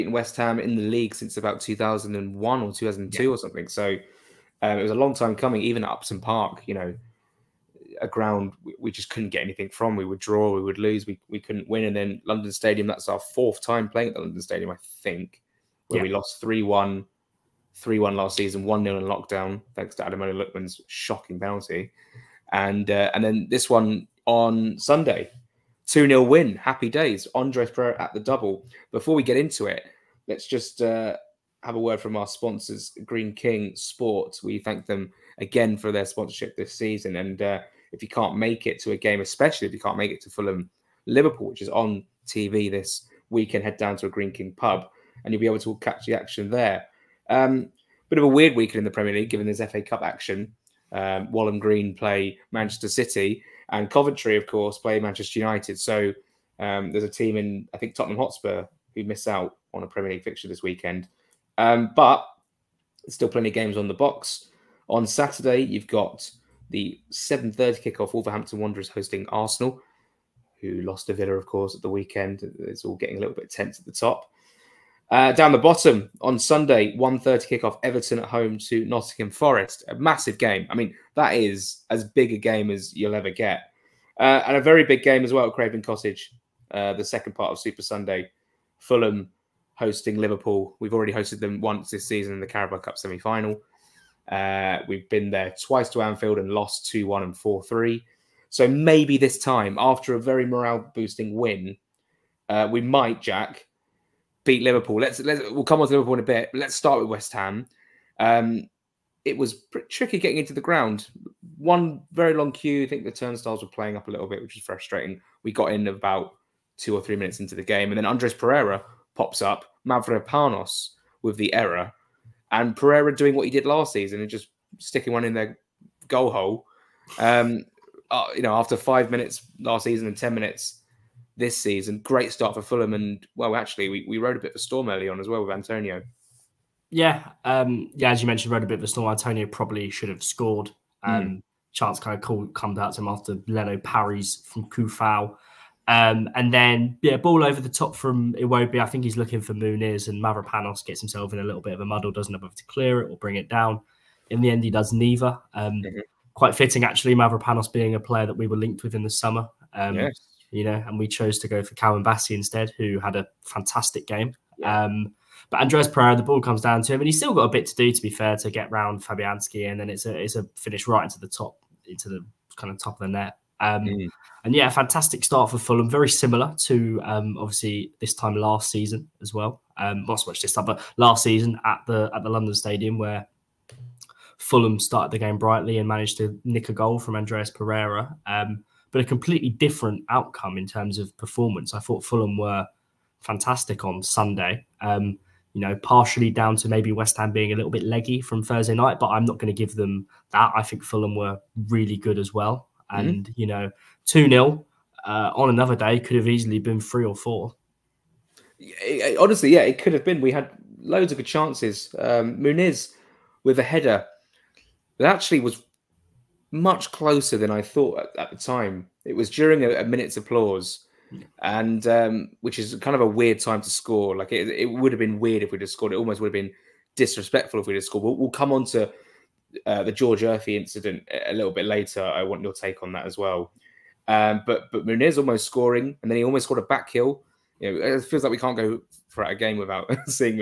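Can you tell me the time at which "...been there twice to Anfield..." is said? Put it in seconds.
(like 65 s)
95 s.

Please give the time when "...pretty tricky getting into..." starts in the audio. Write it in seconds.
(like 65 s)
109 s.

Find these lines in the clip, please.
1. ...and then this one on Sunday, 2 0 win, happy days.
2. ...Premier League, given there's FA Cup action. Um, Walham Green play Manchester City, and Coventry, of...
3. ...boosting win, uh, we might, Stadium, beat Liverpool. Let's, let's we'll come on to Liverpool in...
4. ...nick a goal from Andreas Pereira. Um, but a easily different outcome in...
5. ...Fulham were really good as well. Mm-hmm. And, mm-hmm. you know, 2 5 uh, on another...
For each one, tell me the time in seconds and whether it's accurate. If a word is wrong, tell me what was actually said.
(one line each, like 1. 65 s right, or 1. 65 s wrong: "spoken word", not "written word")
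1. 23 s right
2. 48 s right
3. 100 s wrong: "Jack", not "Stadium"
4. 186 s wrong: "completely", not "easily"
5. 200 s wrong: "0", not "5".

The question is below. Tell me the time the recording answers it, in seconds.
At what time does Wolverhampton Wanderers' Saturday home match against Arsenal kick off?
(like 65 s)
67 s.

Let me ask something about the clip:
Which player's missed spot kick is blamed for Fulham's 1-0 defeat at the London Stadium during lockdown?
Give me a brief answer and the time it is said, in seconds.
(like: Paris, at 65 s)
Adam Lookman, at 20 s.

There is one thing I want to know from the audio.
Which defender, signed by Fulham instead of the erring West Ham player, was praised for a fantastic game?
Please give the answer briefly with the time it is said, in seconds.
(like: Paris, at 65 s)
Calvin Bassey, at 161 s.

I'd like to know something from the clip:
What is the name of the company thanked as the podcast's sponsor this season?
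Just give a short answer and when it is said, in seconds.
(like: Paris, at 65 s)
Greene King Sports, at 33 s.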